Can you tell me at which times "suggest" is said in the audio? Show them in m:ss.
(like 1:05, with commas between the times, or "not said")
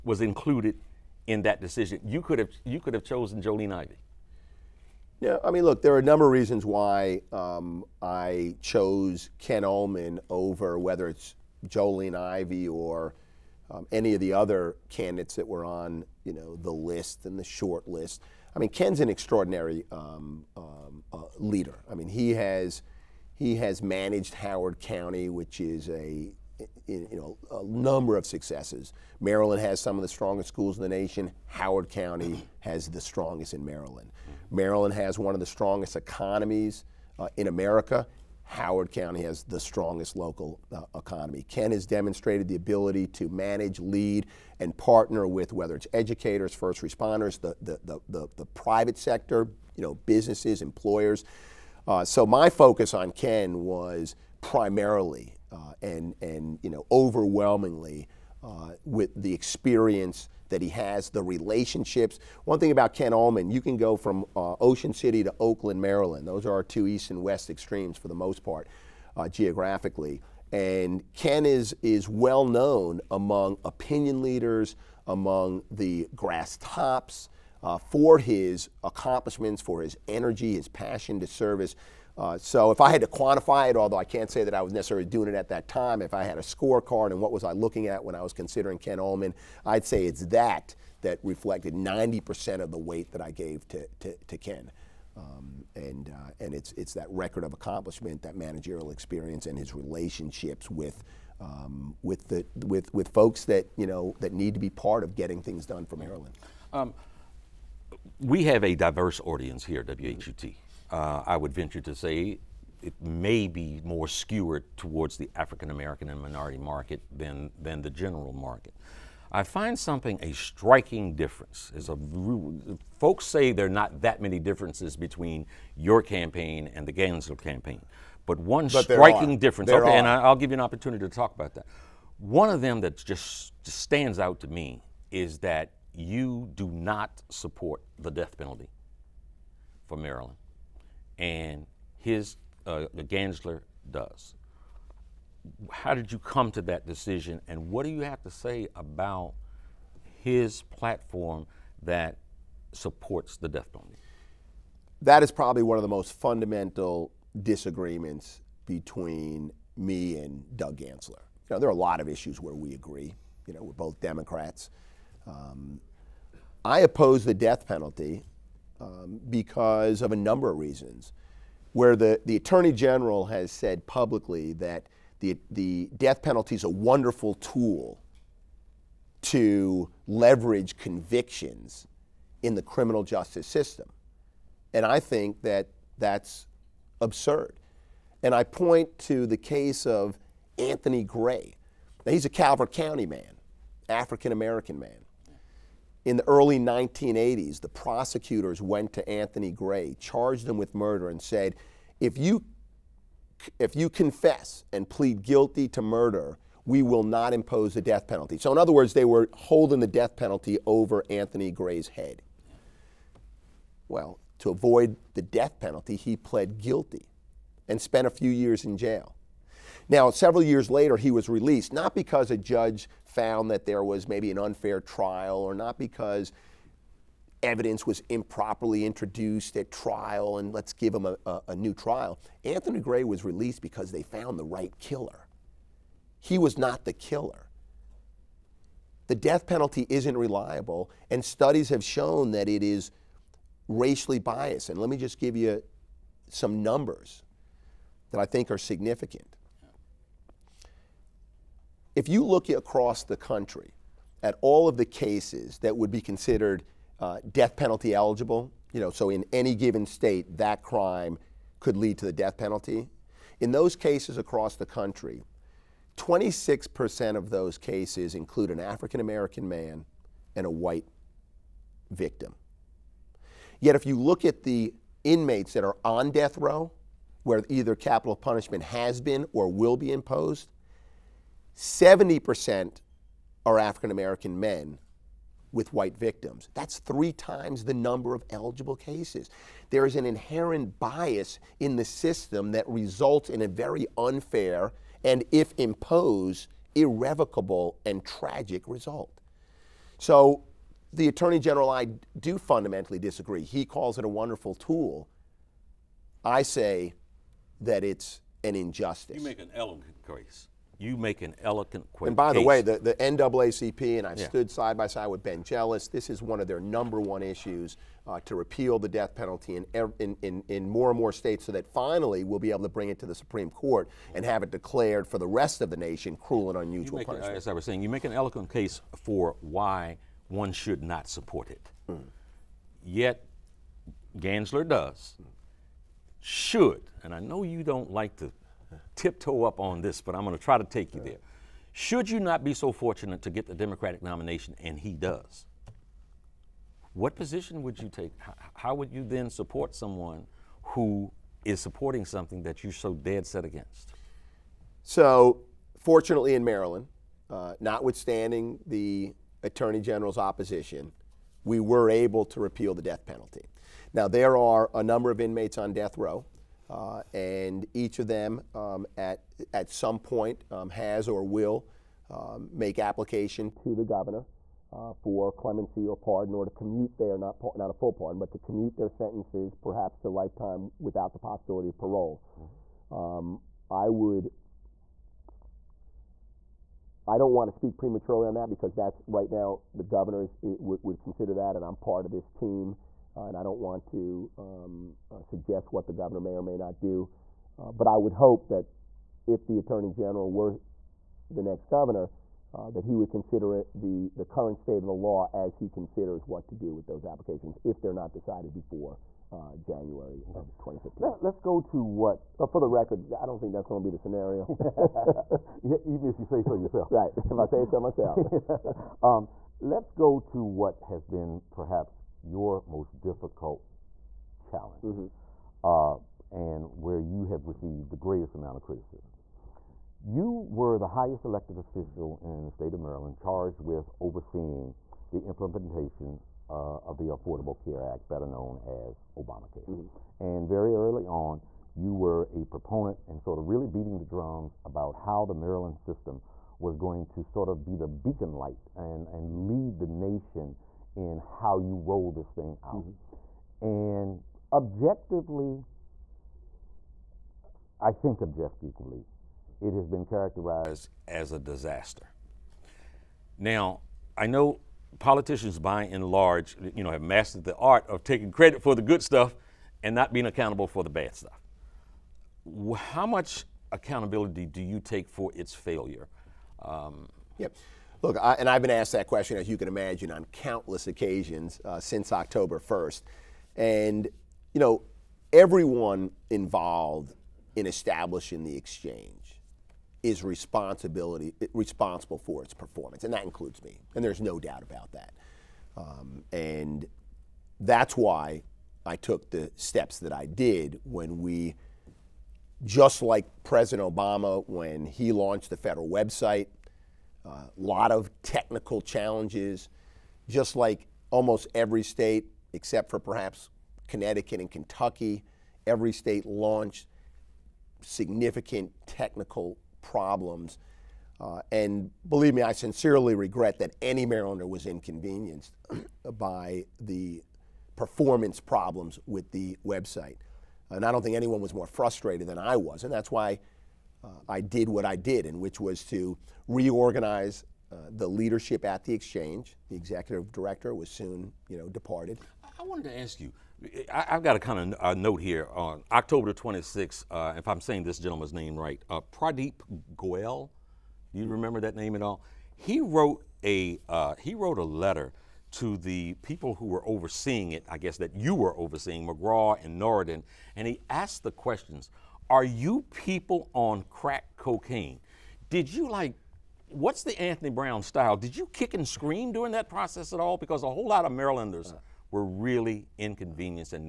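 6:35.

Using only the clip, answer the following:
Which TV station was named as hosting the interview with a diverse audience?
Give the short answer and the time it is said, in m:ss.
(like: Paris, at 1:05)
WHUT, at 1:50.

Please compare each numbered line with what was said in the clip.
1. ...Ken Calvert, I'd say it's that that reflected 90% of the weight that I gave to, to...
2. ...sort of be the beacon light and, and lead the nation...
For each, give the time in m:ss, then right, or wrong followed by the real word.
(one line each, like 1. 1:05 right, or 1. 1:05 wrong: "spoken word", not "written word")
1. 1:28 wrong: "Ulman", not "Calvert"
2. 7:27 right.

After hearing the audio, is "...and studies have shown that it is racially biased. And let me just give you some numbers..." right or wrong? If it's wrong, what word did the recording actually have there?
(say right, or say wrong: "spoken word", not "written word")
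right.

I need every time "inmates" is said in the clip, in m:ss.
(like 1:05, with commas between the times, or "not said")
4:35, 6:05.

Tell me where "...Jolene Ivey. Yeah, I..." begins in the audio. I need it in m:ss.
0:03.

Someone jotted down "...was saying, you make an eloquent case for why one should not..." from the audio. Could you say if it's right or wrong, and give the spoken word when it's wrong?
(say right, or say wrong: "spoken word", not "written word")
right.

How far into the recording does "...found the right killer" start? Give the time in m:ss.
3:54.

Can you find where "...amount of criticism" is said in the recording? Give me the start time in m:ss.
7:08.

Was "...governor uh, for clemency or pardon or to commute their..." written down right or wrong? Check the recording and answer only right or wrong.
right.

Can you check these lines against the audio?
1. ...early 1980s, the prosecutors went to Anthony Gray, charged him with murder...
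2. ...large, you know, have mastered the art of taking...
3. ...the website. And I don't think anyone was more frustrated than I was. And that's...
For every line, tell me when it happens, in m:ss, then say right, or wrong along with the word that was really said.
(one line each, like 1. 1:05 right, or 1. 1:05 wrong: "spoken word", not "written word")
1. 3:16 right
2. 7:46 right
3. 8:49 right.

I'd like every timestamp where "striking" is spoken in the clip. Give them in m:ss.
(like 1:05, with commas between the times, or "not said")
2:00, 2:08.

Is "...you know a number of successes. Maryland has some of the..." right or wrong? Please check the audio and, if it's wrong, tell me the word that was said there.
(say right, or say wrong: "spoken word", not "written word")
right.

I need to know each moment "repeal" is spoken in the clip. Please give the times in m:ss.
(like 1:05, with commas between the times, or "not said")
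5:18, 6:02.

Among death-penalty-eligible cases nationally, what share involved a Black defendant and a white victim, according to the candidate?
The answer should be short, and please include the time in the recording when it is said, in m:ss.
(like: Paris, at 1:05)
26%, at 4:25.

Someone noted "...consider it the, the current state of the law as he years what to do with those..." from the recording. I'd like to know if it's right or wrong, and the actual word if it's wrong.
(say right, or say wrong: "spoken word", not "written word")
wrong: "considers", not "years".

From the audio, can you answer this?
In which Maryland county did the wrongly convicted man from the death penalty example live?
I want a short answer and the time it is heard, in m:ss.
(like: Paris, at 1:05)
Calvert County, at 3:12.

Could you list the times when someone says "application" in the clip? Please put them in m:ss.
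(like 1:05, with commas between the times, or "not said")
6:12, 6:47.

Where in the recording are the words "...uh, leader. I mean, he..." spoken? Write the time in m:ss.
0:21.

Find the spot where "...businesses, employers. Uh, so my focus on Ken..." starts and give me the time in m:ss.
0:50.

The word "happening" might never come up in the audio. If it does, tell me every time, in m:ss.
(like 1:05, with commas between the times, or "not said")
not said.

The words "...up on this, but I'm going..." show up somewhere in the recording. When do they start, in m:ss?
5:39.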